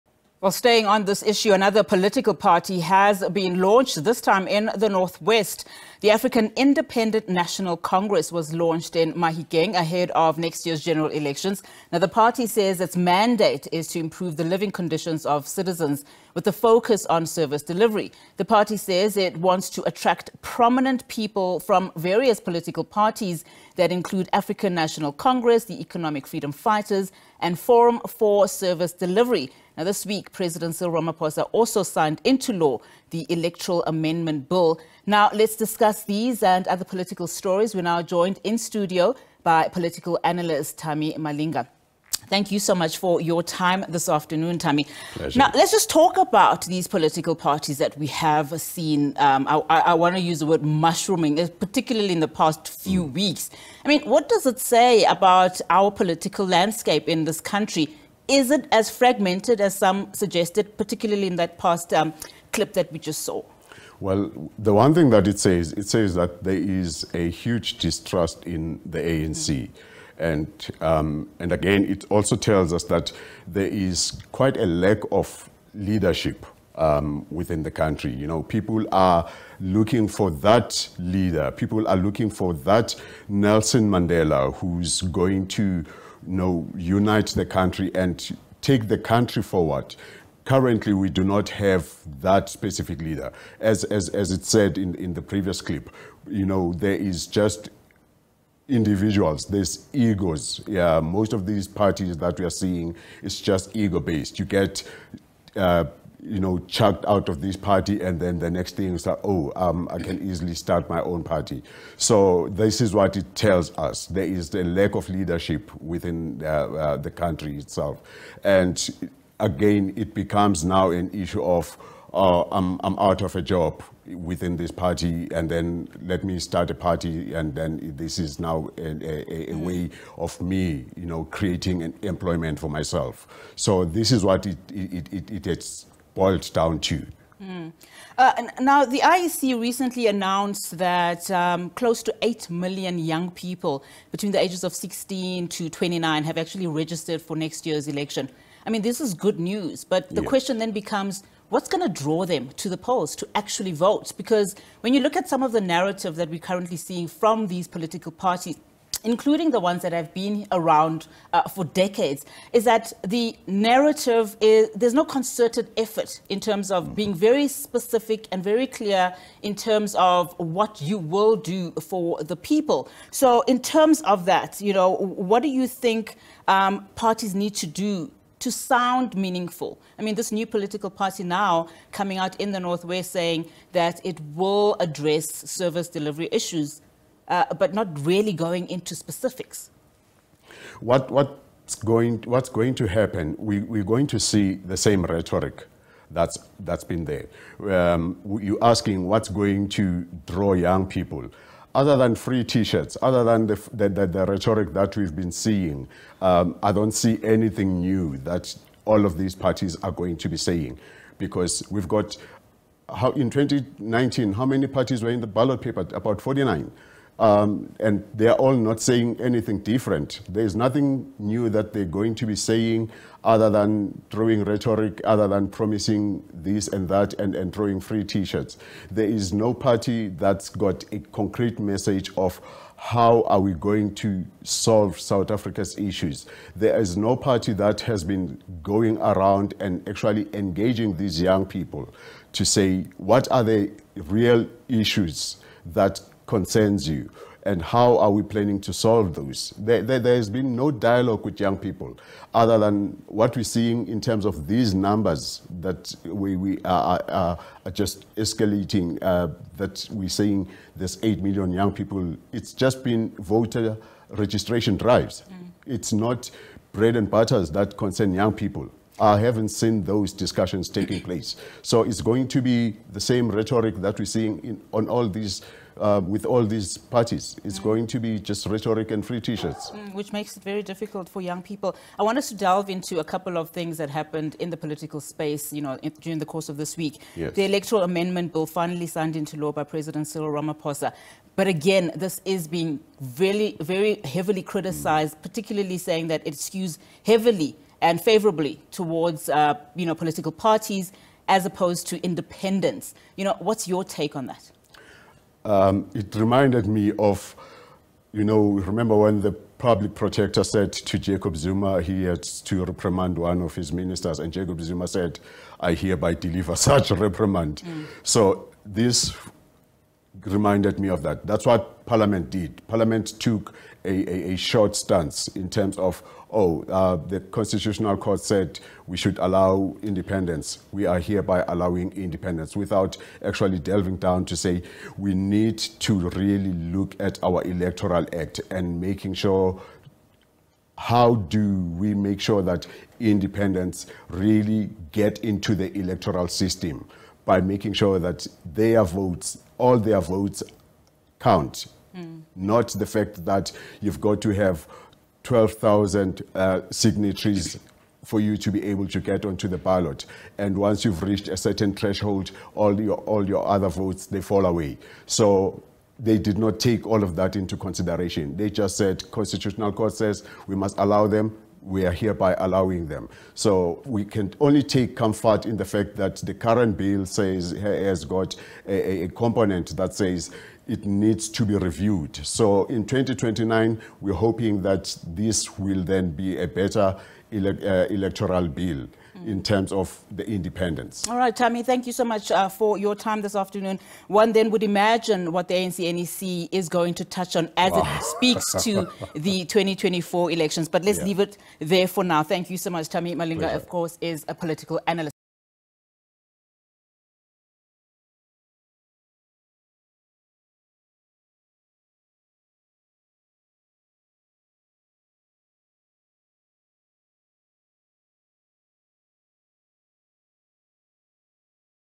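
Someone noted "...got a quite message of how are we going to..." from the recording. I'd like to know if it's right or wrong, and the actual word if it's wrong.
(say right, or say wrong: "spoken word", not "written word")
wrong: "concrete", not "quite".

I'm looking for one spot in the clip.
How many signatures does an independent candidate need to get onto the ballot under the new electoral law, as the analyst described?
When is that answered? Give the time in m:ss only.
5:55.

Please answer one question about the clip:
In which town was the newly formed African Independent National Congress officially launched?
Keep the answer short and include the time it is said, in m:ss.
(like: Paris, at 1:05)
Mahikeng, at 0:09.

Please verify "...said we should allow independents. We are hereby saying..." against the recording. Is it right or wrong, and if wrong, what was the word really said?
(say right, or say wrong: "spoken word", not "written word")
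wrong: "allowing", not "saying".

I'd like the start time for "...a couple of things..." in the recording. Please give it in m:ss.
4:42.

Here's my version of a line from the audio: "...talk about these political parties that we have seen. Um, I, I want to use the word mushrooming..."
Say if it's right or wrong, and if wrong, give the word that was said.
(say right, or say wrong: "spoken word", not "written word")
right.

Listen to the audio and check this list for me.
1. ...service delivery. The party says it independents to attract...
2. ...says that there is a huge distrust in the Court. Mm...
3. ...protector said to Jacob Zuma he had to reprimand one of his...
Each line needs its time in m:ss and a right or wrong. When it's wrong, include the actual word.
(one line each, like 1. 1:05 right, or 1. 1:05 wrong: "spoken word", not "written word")
1. 0:17 wrong: "wants", not "independents"
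2. 1:05 wrong: "ANC", not "Court"
3. 5:09 right.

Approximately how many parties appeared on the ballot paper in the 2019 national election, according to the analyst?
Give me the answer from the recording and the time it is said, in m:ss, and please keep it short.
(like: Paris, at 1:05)
49, at 3:35.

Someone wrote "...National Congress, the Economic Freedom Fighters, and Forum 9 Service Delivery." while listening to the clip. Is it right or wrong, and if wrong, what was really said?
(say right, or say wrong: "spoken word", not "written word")
wrong: "4", not "9".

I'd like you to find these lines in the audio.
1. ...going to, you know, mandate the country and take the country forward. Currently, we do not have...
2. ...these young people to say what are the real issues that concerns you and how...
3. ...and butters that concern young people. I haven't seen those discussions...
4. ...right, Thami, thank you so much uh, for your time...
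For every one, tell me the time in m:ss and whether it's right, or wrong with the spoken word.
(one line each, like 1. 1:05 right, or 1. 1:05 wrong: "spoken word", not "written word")
1. 1:25 wrong: "unite", not "mandate"
2. 4:00 right
3. 4:26 right
4. 6:31 right.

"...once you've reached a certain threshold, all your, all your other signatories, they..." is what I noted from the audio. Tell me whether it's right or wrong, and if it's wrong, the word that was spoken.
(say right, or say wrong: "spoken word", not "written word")
wrong: "votes", not "signatories".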